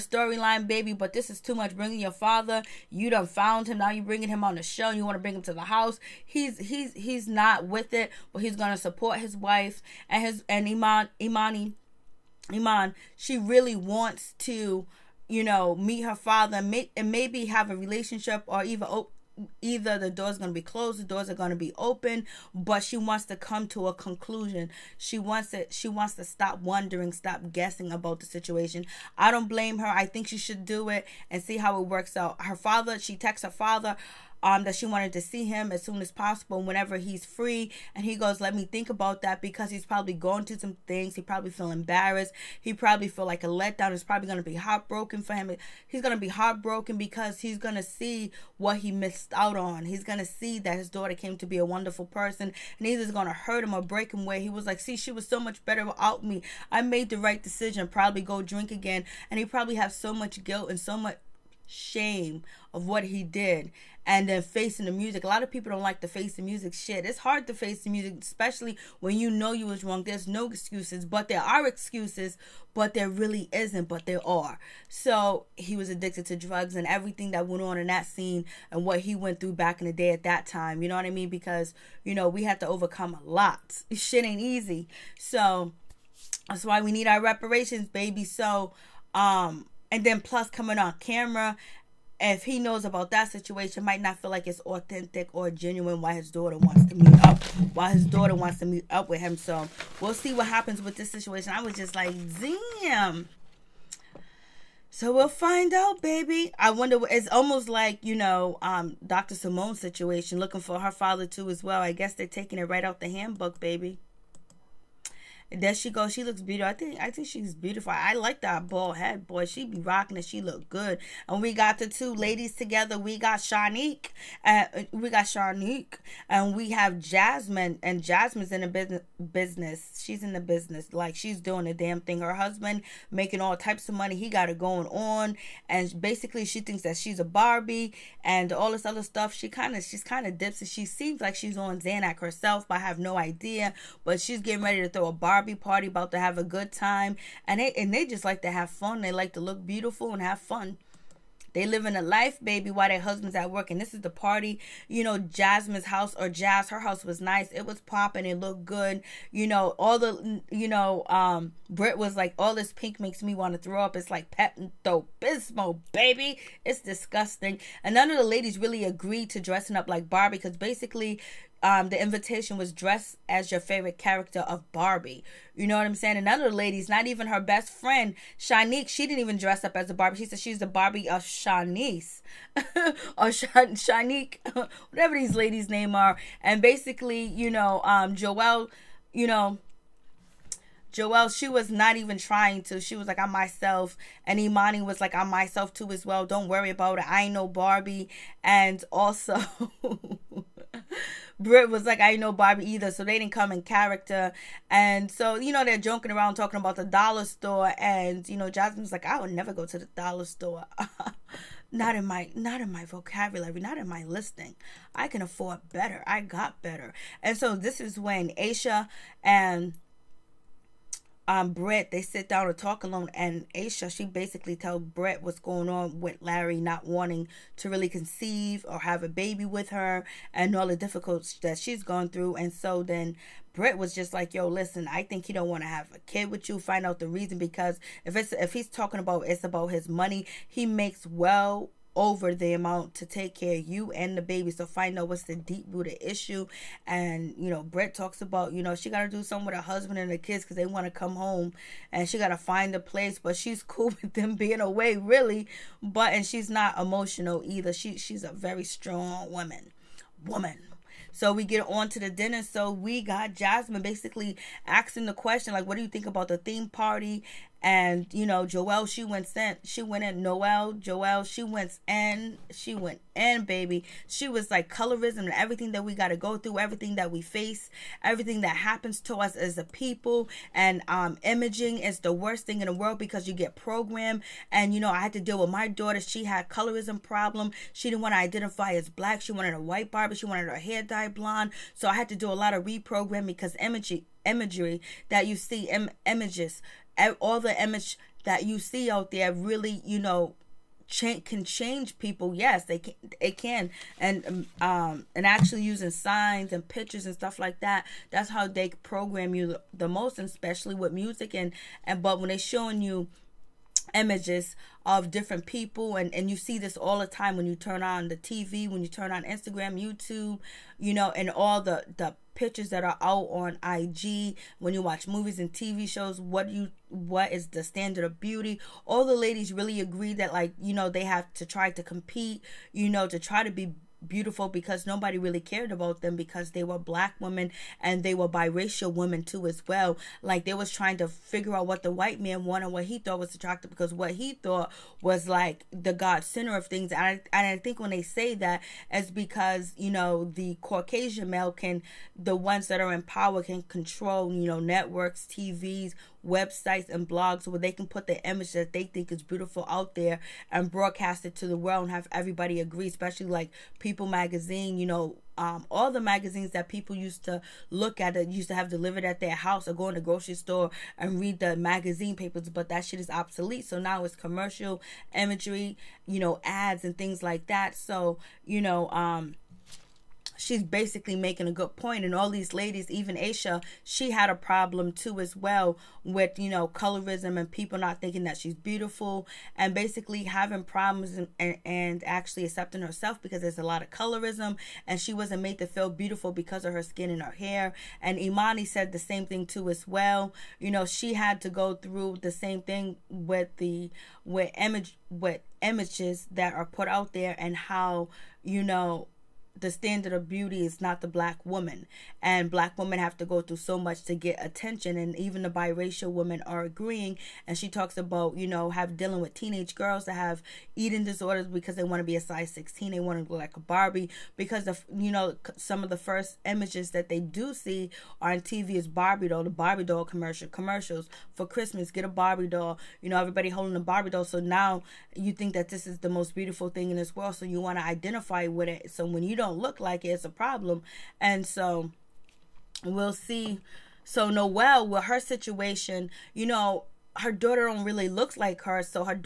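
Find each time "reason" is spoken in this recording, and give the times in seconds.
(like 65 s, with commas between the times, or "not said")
237 s.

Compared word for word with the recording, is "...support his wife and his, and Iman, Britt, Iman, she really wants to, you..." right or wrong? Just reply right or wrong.
wrong.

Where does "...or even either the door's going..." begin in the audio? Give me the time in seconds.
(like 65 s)
18 s.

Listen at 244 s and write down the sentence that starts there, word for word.
So find out what's the deep rooted issue.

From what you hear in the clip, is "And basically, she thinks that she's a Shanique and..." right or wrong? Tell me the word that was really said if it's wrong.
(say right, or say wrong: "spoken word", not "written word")
wrong: "Barbie", not "Shanique".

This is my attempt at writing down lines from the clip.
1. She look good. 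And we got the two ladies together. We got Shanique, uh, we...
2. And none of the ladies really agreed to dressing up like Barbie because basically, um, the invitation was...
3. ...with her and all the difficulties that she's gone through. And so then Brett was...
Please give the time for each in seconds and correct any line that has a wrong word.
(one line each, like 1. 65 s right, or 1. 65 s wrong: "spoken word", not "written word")
1. 120 s right
2. 167 s right
3. 229 s right.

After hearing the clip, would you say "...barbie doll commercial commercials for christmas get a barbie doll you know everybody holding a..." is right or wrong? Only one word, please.
right.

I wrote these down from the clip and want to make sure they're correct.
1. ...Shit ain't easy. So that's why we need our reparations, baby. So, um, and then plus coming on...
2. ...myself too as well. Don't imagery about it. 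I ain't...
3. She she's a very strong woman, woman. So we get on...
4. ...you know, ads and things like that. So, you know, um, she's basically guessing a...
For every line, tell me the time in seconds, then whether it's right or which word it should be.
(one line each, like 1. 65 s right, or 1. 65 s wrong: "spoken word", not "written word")
1. 83 s right
2. 195 s wrong: "worry", not "imagery"
3. 257 s right
4. 376 s wrong: "making", not "guessing".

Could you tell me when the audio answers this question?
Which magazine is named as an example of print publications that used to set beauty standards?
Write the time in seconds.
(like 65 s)
363 s.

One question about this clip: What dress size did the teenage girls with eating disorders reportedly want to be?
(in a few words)
16.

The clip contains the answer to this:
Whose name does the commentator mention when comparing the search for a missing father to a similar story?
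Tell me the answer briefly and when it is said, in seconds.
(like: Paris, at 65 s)
Dr. Simone, at 109 s.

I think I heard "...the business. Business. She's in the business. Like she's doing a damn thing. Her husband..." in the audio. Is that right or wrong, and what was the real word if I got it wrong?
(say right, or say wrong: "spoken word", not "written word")
right.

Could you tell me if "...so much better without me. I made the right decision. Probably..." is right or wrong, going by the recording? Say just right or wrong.
right.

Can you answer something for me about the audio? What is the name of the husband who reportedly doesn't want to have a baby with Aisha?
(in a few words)
Larry.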